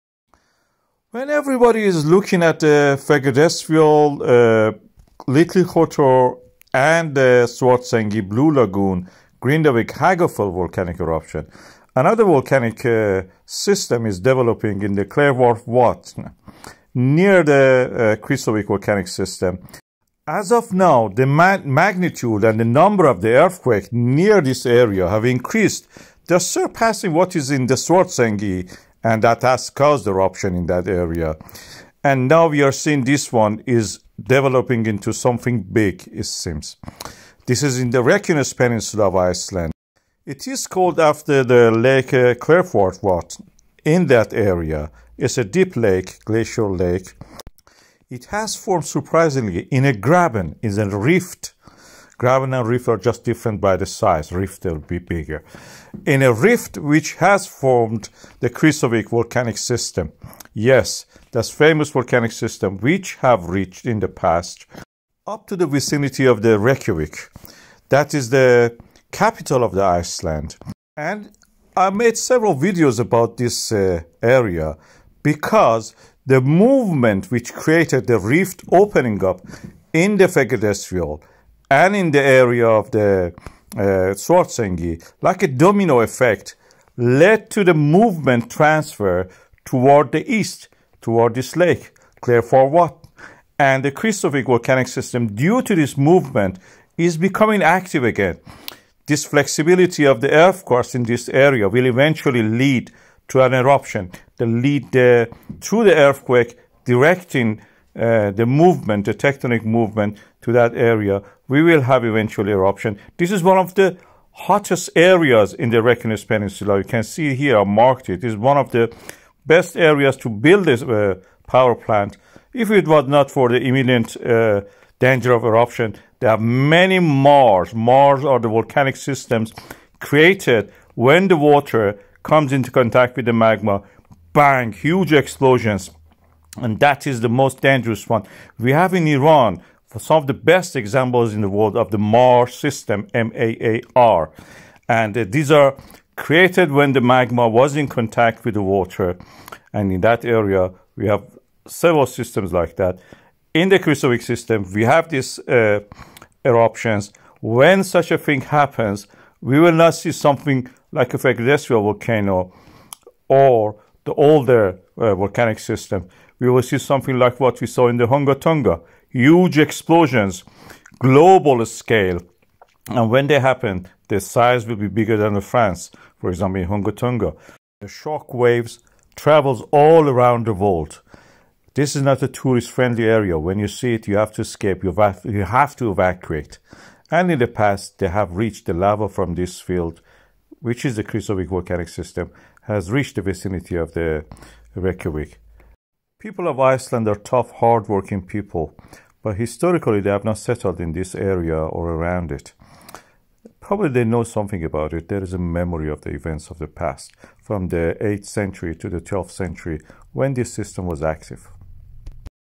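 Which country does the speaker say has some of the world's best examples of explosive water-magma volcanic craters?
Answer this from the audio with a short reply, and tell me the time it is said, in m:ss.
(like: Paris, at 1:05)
Iran, at 2:18.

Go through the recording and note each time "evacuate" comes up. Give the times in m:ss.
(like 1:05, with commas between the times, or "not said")
3:05.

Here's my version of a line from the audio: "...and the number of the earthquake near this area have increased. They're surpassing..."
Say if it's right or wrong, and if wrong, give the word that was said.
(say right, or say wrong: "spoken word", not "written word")
right.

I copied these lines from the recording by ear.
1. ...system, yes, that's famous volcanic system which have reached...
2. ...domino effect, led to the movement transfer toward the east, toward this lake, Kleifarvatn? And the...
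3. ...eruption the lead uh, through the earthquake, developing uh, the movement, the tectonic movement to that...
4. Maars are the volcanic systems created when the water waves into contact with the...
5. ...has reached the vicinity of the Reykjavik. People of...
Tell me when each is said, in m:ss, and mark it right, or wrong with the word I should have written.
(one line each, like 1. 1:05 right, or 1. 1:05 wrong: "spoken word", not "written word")
1. 0:59 right
2. 1:25 right
3. 1:43 wrong: "directing", not "developing"
4. 2:07 wrong: "comes", not "waves"
5. 3:12 right.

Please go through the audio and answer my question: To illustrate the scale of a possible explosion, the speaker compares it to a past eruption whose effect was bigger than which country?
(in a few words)
France.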